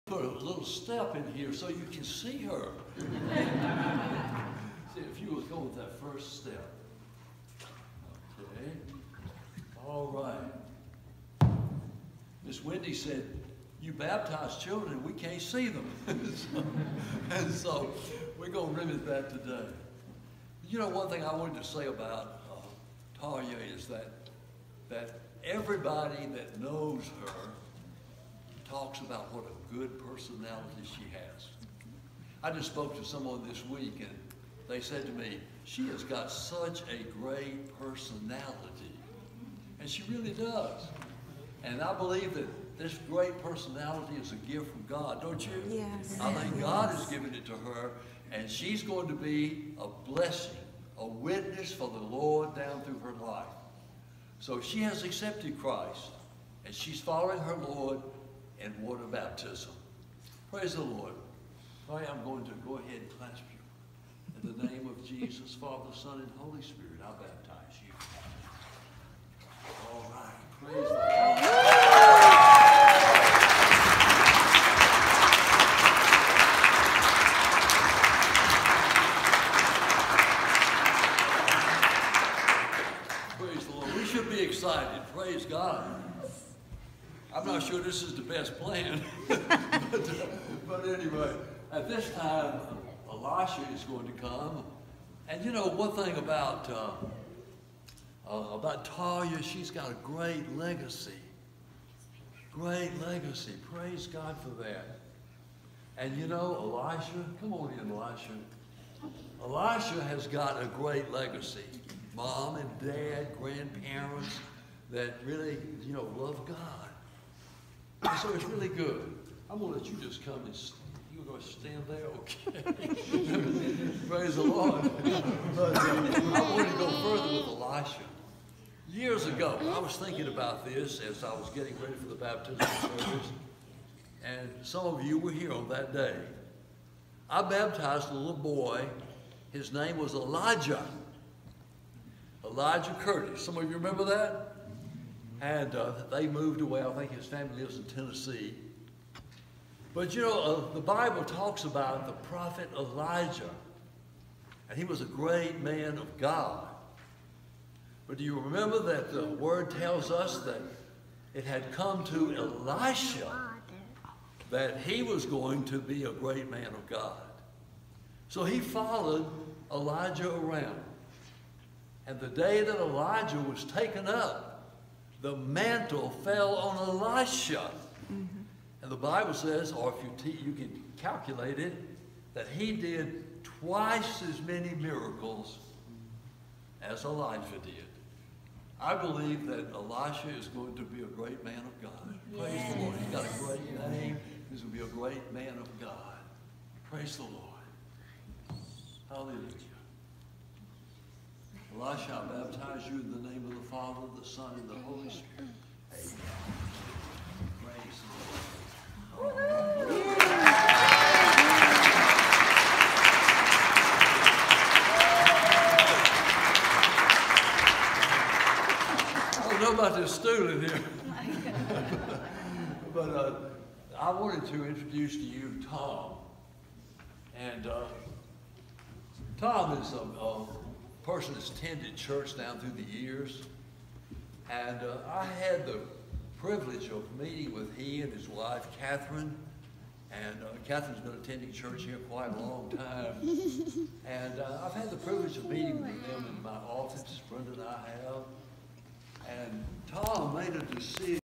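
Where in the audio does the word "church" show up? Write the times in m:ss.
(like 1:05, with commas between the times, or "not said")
3:51, 4:01.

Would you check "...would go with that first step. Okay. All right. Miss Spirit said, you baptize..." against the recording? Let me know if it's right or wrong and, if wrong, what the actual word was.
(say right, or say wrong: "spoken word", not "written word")
wrong: "Wendy", not "Spirit".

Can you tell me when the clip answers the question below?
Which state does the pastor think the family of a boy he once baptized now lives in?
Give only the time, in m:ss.
2:27.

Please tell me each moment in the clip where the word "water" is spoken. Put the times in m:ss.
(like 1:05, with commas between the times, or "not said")
0:58.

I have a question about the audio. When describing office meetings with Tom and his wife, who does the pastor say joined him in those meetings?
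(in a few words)
Brenda.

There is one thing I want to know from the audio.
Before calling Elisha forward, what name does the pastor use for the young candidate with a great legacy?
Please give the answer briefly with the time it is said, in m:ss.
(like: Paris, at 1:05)
Talia, at 1:38.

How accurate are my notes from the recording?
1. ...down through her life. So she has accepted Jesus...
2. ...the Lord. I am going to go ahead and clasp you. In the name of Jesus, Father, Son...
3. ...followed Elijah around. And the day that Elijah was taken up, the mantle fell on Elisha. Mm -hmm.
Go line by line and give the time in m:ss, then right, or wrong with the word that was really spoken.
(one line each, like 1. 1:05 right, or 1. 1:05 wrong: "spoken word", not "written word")
1. 0:52 wrong: "Christ", not "Jesus"
2. 1:00 right
3. 2:48 right.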